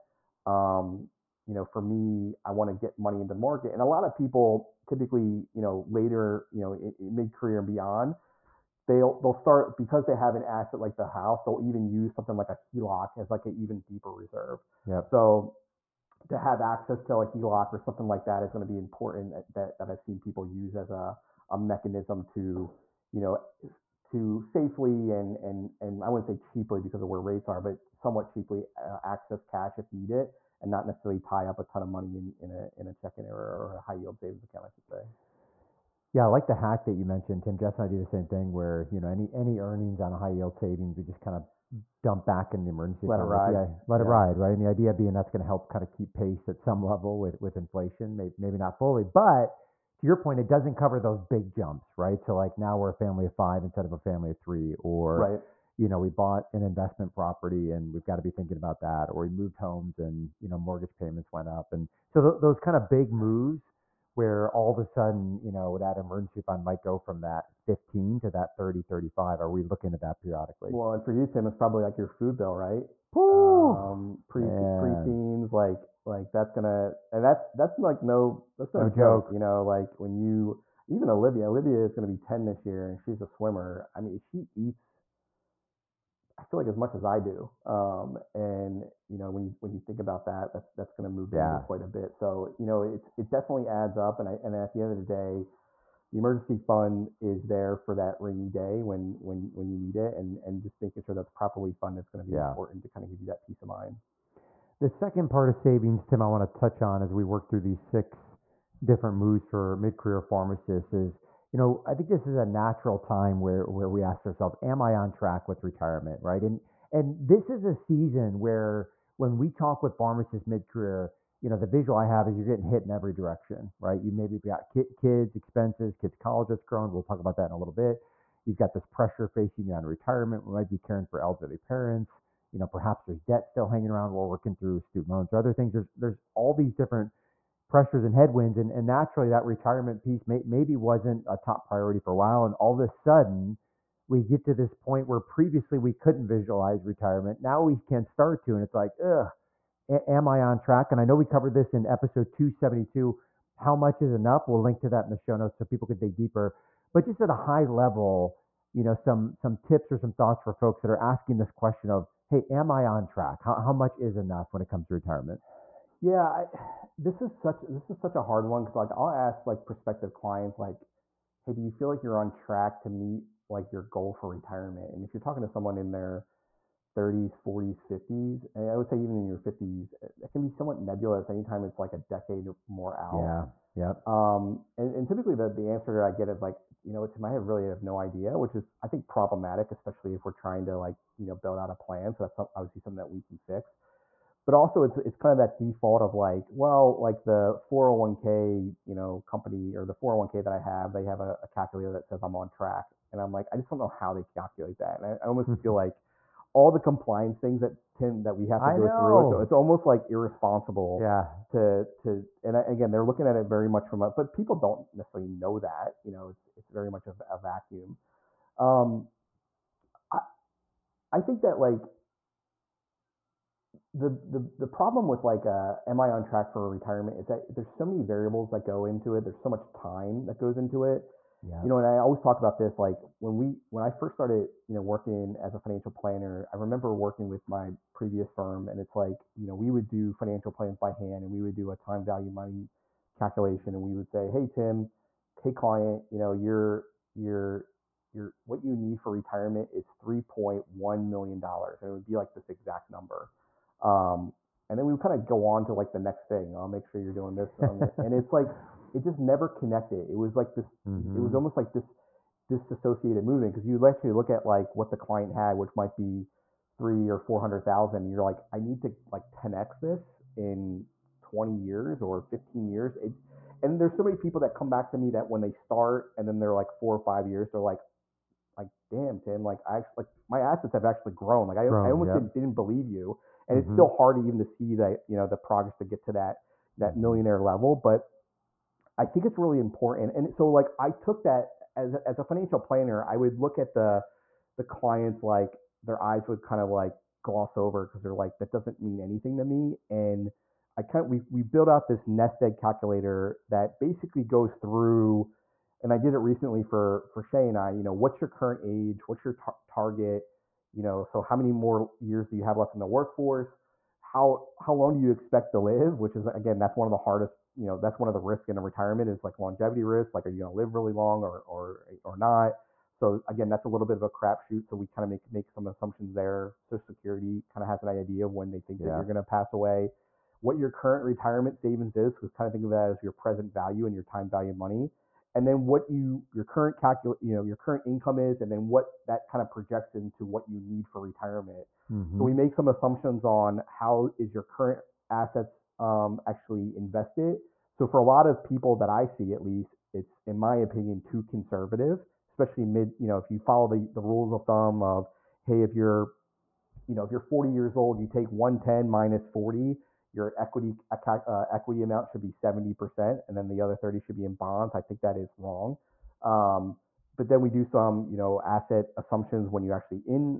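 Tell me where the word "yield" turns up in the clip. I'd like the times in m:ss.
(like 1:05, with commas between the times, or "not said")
0:33, 0:40.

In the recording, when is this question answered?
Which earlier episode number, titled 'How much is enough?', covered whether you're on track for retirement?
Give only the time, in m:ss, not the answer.
2:31.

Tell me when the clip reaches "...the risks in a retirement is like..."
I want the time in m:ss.
5:18.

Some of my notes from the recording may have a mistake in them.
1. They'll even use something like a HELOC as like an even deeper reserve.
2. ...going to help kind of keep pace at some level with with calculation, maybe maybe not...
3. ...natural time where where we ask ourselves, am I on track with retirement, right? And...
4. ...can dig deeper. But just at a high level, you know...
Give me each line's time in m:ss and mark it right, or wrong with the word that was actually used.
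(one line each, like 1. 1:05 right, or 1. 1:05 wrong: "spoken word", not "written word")
1. 0:11 right
2. 0:45 wrong: "inflation", not "calculation"
3. 1:52 right
4. 2:35 right.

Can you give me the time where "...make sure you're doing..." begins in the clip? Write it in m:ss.
4:16.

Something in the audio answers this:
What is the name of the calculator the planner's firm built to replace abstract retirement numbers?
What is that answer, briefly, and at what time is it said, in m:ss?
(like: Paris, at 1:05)
Nest egg calculator, at 5:02.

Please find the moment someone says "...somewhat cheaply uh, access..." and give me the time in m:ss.
0:27.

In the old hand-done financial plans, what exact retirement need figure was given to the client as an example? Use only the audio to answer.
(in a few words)
3.1 million dollars.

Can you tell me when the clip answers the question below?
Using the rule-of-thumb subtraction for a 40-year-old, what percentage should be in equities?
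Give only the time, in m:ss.
6:02.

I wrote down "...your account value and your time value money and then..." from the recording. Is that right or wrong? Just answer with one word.
wrong.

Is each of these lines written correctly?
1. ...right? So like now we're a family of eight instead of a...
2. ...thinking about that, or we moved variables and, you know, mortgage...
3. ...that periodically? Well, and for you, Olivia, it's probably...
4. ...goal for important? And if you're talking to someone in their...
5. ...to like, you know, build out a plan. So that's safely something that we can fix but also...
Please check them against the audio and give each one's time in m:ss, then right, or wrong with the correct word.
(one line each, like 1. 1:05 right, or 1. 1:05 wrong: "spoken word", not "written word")
1. 0:51 wrong: "five", not "eight"
2. 0:58 wrong: "homes", not "variables"
3. 1:10 wrong: "Tim", not "Olivia"
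4. 2:53 wrong: "retirement", not "important"
5. 3:10 wrong: "obviously", not "safely".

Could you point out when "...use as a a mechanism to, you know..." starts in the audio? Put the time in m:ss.
0:20.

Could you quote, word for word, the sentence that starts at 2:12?
You know, perhaps there's debt still hanging around.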